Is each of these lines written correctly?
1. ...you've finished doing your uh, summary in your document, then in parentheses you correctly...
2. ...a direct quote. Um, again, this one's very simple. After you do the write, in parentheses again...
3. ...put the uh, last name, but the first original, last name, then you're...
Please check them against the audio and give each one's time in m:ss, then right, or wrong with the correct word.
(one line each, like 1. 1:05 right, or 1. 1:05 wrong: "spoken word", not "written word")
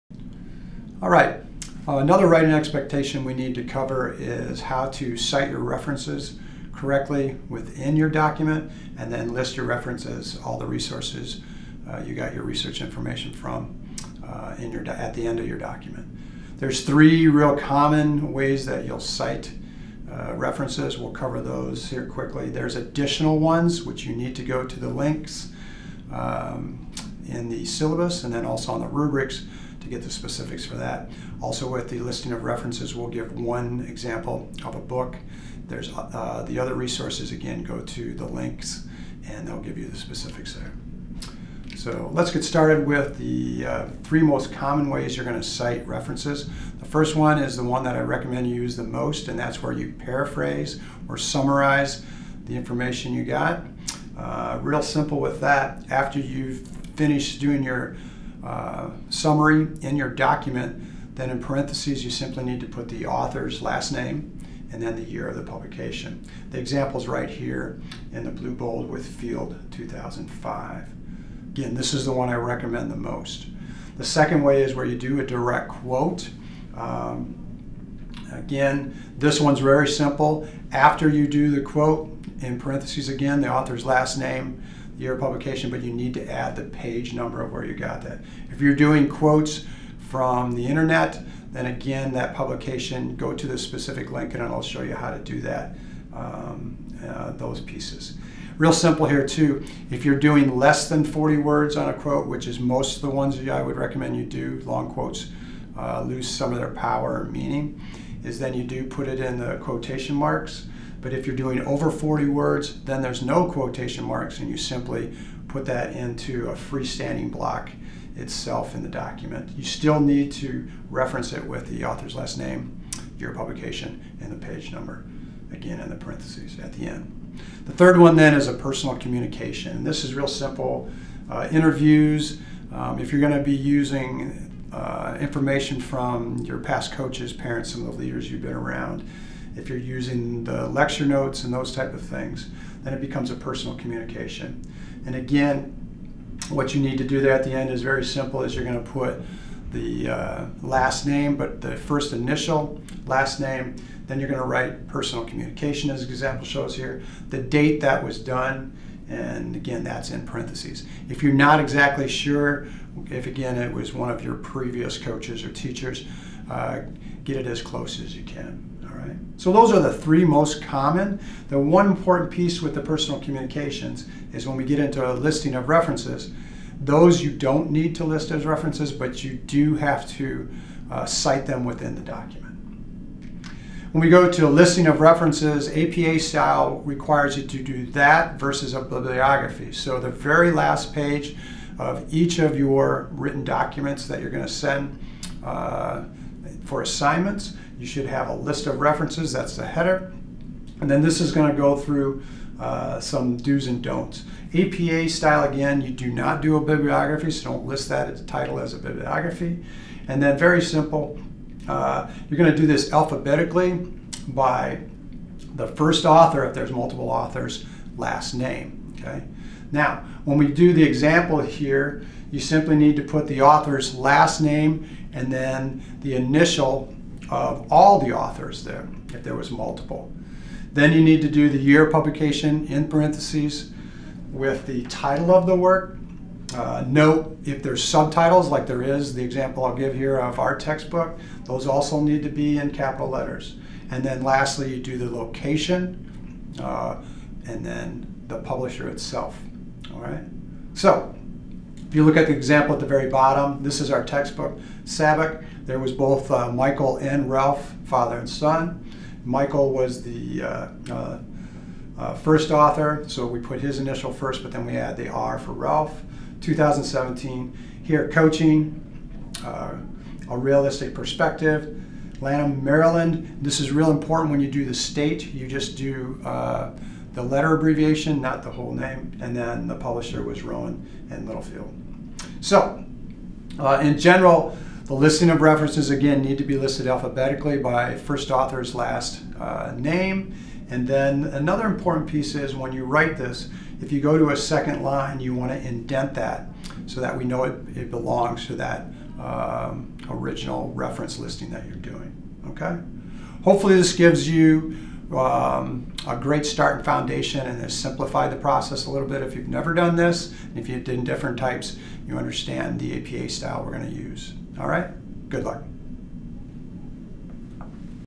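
1. 0:56 wrong: "simply", not "correctly"
2. 1:15 wrong: "quote", not "write"
3. 2:28 wrong: "initial", not "original".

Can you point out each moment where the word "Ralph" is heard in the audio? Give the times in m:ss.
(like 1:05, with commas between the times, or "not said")
4:17, 4:25.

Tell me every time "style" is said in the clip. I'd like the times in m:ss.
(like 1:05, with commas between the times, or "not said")
3:06, 3:25, 5:13.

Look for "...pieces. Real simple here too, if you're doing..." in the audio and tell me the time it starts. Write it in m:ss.
1:37.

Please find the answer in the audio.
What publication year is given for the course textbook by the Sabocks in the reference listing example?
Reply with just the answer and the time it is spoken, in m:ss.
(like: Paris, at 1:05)
2017, at 4:26.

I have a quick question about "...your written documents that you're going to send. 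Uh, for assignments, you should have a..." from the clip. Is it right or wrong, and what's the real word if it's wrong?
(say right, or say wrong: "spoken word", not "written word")
right.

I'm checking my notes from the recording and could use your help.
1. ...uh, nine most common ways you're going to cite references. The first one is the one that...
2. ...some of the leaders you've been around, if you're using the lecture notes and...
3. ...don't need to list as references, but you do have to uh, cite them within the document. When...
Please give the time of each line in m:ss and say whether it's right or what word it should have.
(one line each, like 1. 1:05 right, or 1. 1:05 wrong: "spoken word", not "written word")
1. 0:43 wrong: "three", not "nine"
2. 2:17 right
3. 2:57 right.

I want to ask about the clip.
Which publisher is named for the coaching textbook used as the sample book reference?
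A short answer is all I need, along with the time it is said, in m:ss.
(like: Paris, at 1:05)
Rowman and Littlefield, at 4:40.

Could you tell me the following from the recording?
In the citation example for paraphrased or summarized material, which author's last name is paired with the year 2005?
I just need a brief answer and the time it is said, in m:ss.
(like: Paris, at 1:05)
Field, at 1:09.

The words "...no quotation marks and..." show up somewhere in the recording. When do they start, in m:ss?
1:53.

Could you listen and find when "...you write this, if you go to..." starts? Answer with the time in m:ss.
4:52.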